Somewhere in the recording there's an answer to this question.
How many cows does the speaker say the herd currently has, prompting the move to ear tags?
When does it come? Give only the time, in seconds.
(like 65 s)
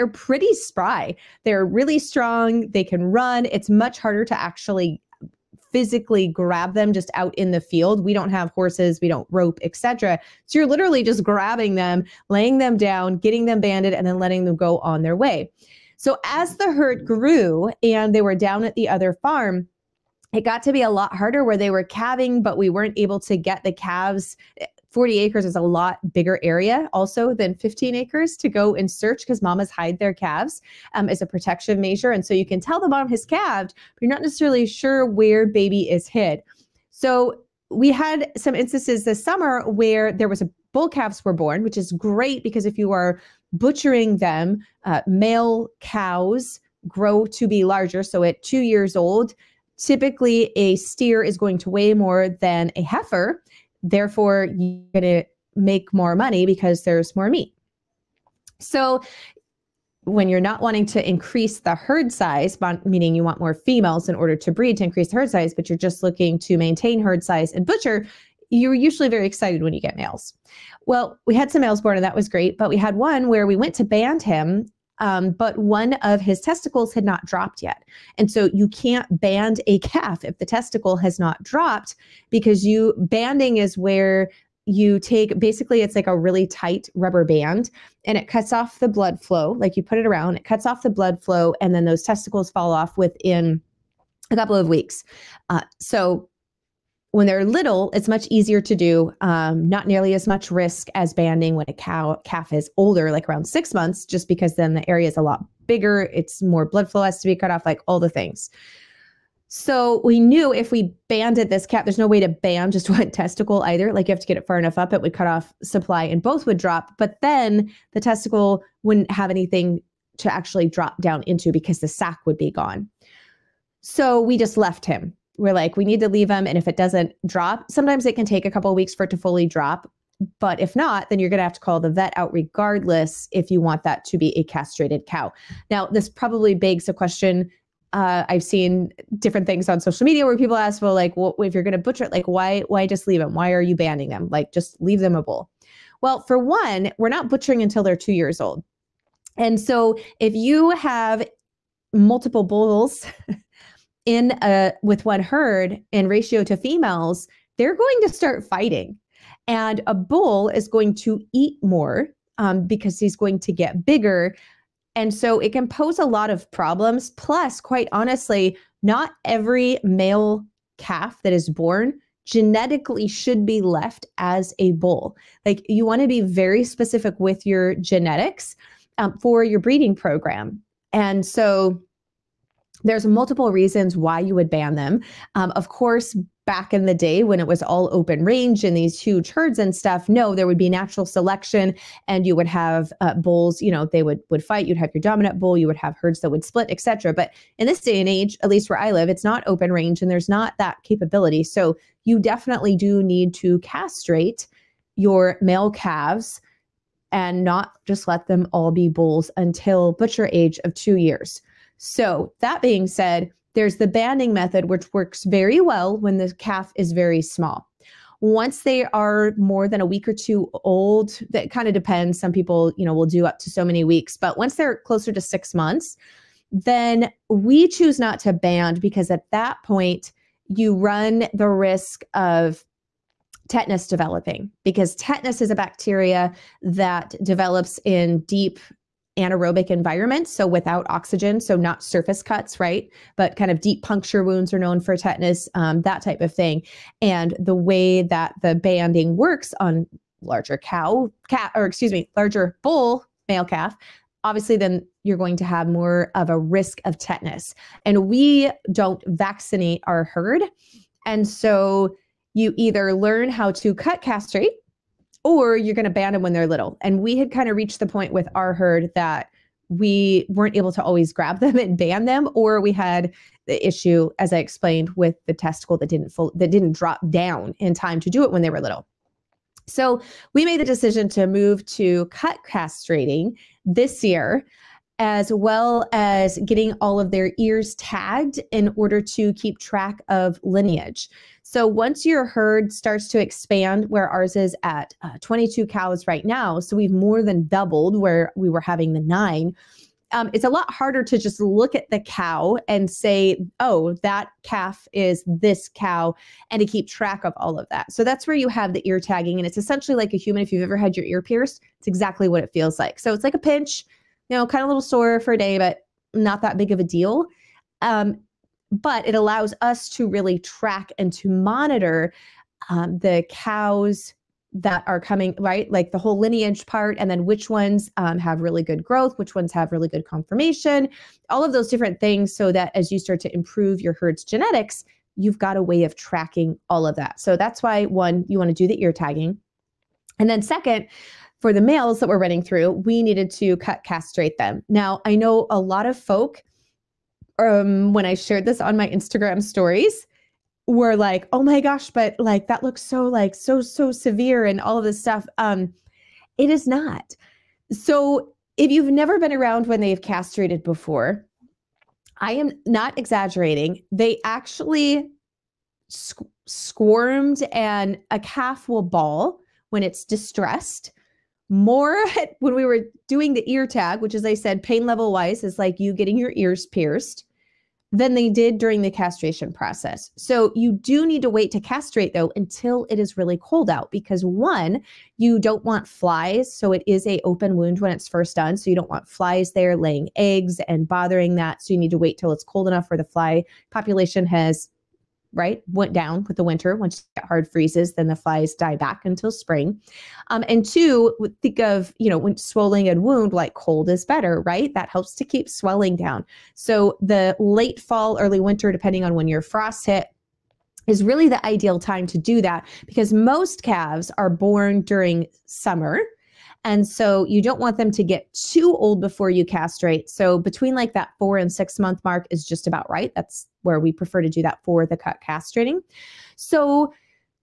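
295 s.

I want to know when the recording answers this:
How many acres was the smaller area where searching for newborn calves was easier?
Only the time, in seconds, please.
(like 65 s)
27 s.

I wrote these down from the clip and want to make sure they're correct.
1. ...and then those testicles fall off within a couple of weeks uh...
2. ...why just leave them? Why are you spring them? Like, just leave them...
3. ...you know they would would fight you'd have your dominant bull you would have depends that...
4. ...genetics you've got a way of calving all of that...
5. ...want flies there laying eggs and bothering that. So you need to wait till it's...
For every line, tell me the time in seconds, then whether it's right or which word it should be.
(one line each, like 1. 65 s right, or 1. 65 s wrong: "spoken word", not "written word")
1. 91 s right
2. 142 s wrong: "banning", not "spring"
3. 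193 s wrong: "herds", not "depends"
4. 334 s wrong: "tracking", not "calving"
5. 388 s right.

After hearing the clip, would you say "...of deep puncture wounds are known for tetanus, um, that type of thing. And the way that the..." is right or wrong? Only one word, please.
right.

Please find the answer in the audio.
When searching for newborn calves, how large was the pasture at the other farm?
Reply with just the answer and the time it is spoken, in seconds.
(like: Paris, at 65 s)
40 acres, at 24 s.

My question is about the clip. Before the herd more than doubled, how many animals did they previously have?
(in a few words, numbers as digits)
9.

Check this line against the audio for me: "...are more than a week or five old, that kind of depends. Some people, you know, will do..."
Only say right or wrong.
wrong.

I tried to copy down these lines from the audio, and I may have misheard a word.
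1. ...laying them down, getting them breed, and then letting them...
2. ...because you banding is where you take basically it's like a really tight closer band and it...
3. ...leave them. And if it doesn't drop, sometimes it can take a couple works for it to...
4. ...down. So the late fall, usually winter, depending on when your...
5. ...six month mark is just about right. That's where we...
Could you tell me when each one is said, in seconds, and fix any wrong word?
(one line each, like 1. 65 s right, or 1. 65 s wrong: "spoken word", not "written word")
1. 12 s wrong: "banded", not "breed"
2. 82 s wrong: "rubber", not "closer"
3. 126 s wrong: "weeks", not "works"
4. 405 s wrong: "early", not "usually"
5. 421 s right.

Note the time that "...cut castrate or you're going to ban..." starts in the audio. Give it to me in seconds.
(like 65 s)
263 s.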